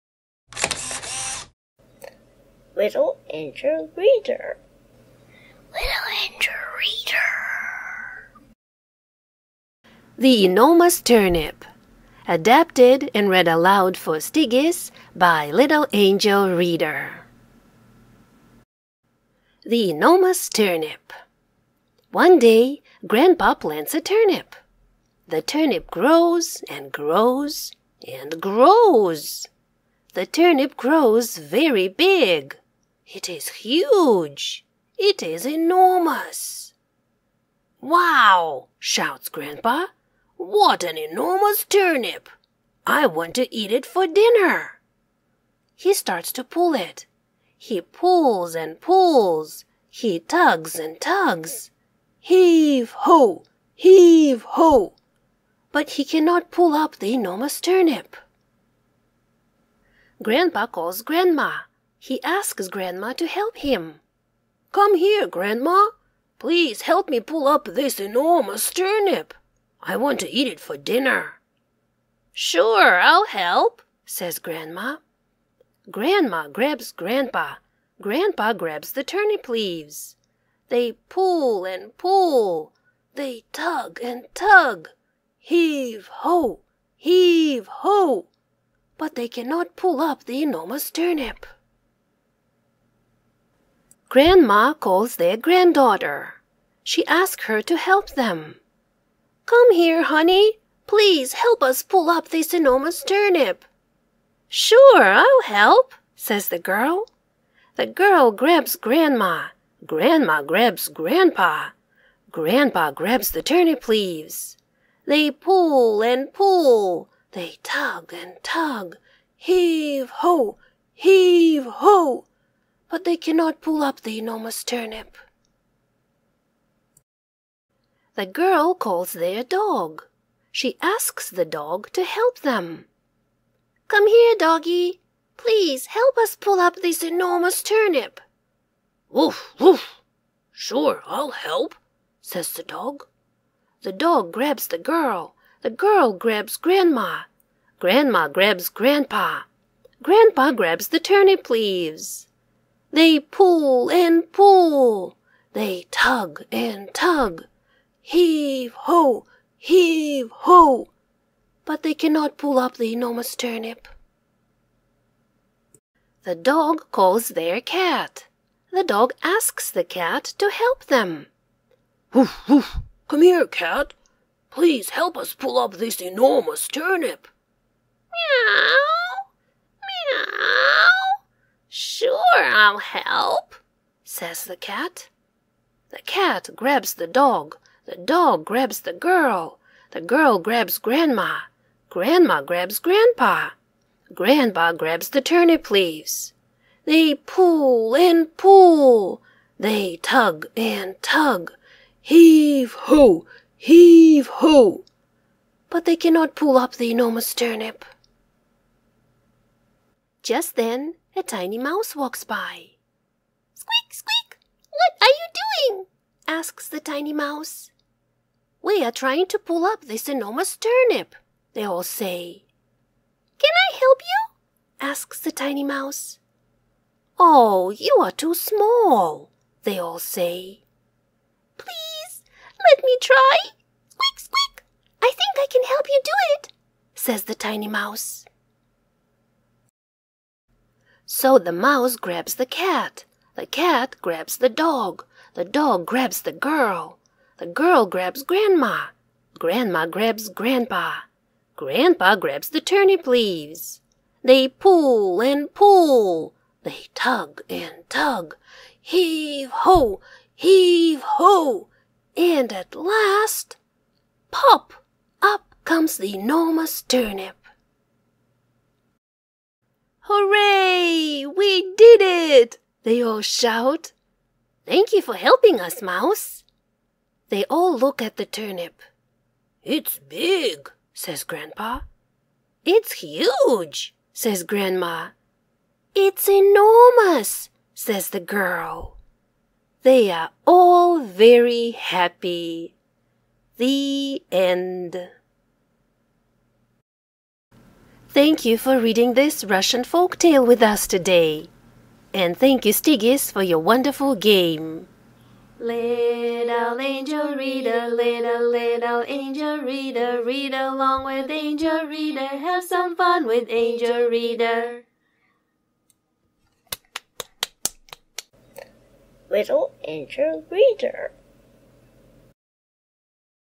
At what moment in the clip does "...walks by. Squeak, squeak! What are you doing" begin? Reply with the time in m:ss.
3:31.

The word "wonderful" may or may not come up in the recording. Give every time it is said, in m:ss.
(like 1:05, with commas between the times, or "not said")
5:03.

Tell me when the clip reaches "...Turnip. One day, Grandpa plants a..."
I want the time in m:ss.
0:20.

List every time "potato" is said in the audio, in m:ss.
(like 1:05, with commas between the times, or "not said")
not said.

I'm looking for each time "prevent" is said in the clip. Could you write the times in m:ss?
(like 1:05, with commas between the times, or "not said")
not said.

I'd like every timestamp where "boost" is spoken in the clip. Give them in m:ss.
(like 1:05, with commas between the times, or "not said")
not said.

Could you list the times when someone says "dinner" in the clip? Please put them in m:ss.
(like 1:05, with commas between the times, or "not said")
0:44, 1:10.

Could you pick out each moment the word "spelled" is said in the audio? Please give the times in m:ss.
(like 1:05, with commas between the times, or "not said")
not said.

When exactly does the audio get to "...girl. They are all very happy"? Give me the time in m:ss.
4:48.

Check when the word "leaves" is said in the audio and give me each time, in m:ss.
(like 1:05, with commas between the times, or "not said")
1:19, 1:53, 2:31, 3:15, 4:13.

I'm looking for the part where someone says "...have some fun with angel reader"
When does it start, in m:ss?
5:12.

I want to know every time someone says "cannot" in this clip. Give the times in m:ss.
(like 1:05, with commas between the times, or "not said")
0:56, 1:29, 2:03, 2:41, 3:25.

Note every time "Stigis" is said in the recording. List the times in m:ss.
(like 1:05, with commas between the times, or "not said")
0:14, 5:02.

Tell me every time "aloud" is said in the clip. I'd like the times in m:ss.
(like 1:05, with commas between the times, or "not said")
0:13.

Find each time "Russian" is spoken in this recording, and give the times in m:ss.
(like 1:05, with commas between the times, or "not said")
4:59.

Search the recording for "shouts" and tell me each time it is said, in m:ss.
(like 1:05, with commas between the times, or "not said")
0:38, 4:33.